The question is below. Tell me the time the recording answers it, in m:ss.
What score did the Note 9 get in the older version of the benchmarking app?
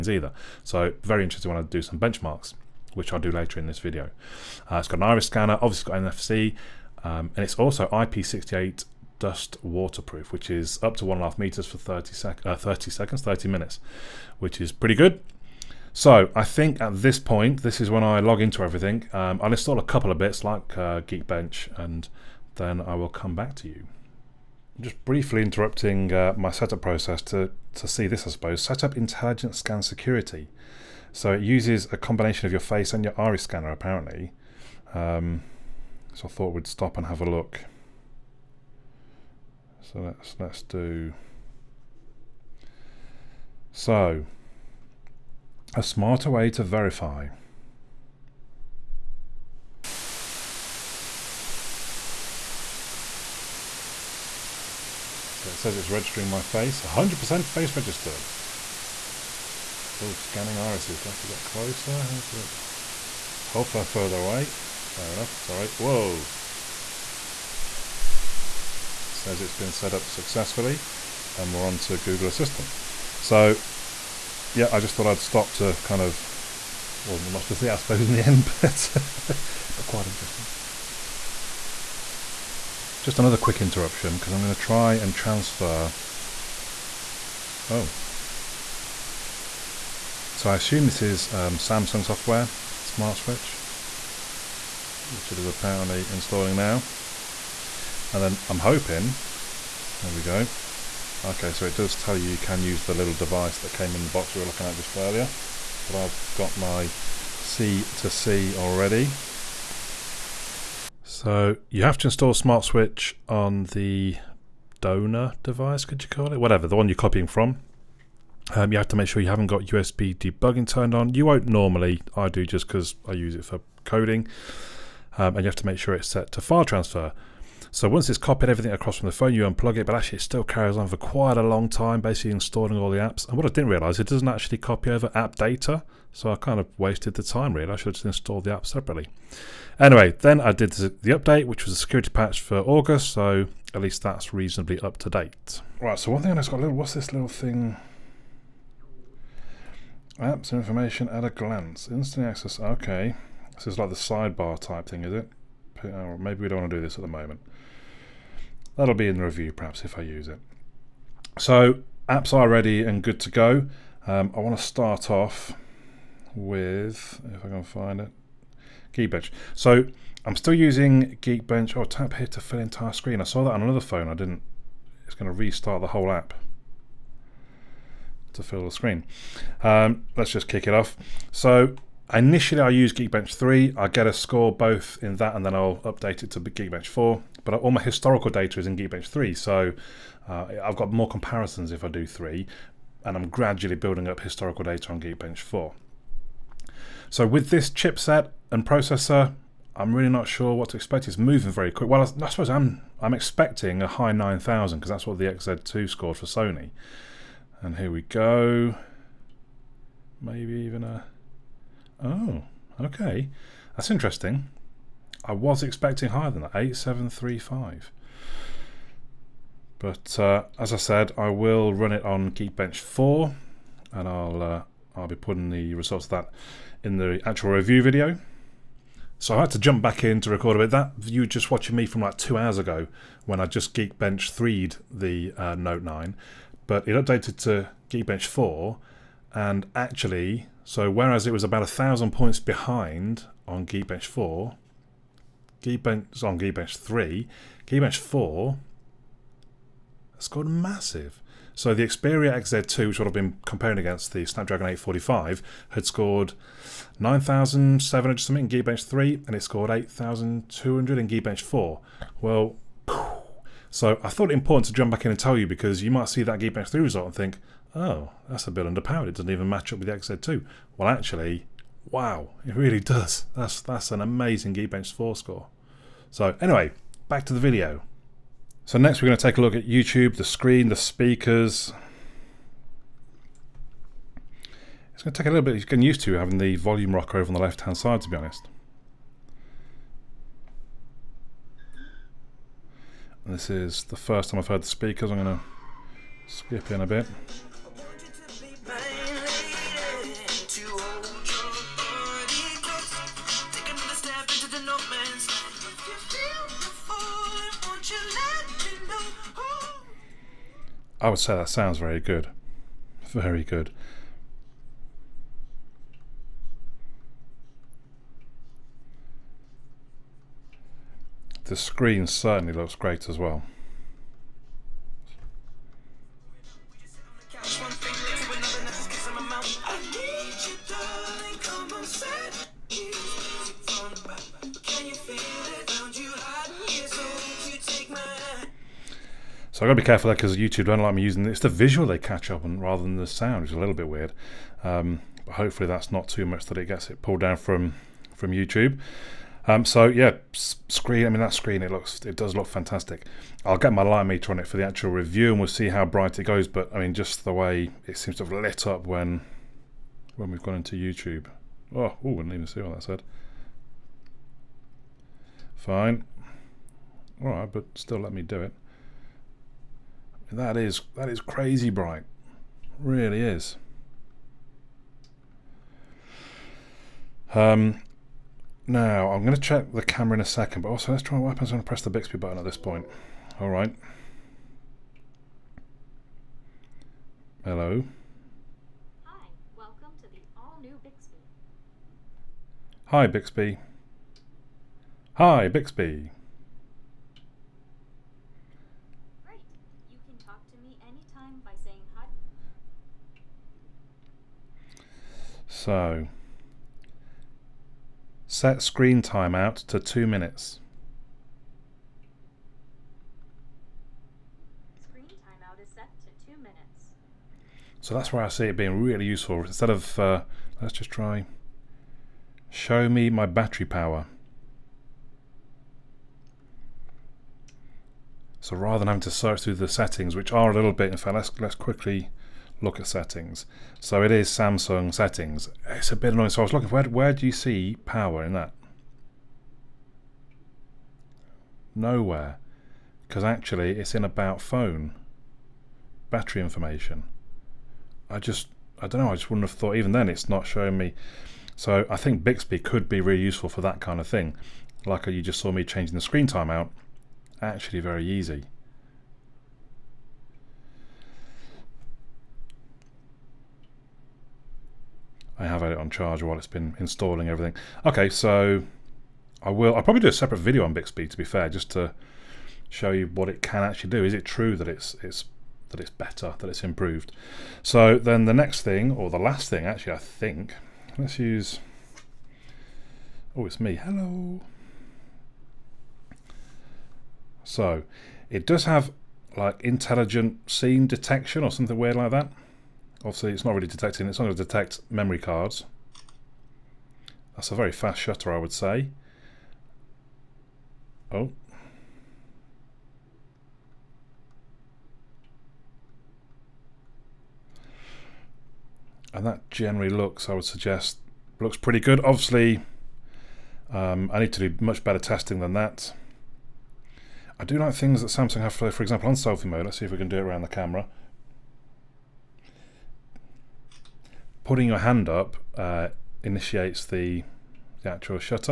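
3:36.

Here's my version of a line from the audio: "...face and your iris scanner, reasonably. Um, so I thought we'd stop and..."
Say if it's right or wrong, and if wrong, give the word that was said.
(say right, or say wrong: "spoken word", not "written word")
wrong: "apparently", not "reasonably".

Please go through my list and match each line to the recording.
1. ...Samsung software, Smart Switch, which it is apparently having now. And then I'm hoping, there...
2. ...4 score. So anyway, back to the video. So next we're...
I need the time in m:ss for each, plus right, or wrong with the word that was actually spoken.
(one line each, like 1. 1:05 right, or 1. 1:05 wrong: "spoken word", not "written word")
1. 1:31 wrong: "installing", not "having"
2. 4:34 right.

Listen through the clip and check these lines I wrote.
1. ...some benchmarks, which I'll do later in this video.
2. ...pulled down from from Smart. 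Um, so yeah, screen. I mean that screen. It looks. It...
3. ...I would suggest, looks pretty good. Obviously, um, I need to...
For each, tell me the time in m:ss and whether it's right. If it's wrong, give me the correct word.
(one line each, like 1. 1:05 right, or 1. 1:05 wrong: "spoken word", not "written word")
1. 0:01 right
2. 5:47 wrong: "YouTube", not "Smart"
3. 8:30 right.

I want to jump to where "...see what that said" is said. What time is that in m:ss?
6:02.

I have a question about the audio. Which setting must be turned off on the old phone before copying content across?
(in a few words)
USB debugging.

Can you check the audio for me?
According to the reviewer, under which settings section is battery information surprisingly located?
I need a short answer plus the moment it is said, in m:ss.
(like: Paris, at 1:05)
About phone, at 7:24.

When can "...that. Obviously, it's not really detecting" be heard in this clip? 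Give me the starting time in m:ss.
8:12.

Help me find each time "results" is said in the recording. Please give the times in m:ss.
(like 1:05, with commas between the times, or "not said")
3:45, 4:26.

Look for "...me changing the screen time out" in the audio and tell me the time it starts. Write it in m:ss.
7:35.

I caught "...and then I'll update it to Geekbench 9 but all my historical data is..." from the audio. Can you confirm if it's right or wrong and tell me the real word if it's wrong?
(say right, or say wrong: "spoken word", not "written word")
wrong: "4", not "9".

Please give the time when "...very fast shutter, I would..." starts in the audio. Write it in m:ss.
8:17.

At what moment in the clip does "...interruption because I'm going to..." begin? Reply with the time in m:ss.
1:23.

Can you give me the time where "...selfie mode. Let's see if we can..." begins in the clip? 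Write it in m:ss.
8:39.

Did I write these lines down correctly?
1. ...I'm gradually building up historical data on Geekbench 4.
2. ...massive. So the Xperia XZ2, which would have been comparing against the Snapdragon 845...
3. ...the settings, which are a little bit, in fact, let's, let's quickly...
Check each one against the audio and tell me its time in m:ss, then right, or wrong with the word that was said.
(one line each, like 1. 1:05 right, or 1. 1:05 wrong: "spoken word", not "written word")
1. 3:13 right
2. 4:10 right
3. 7:09 right.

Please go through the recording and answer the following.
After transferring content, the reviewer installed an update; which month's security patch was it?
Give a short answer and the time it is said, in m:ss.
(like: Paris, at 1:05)
August, at 2:22.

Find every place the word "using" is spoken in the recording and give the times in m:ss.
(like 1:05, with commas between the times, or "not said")
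2:50, 5:41.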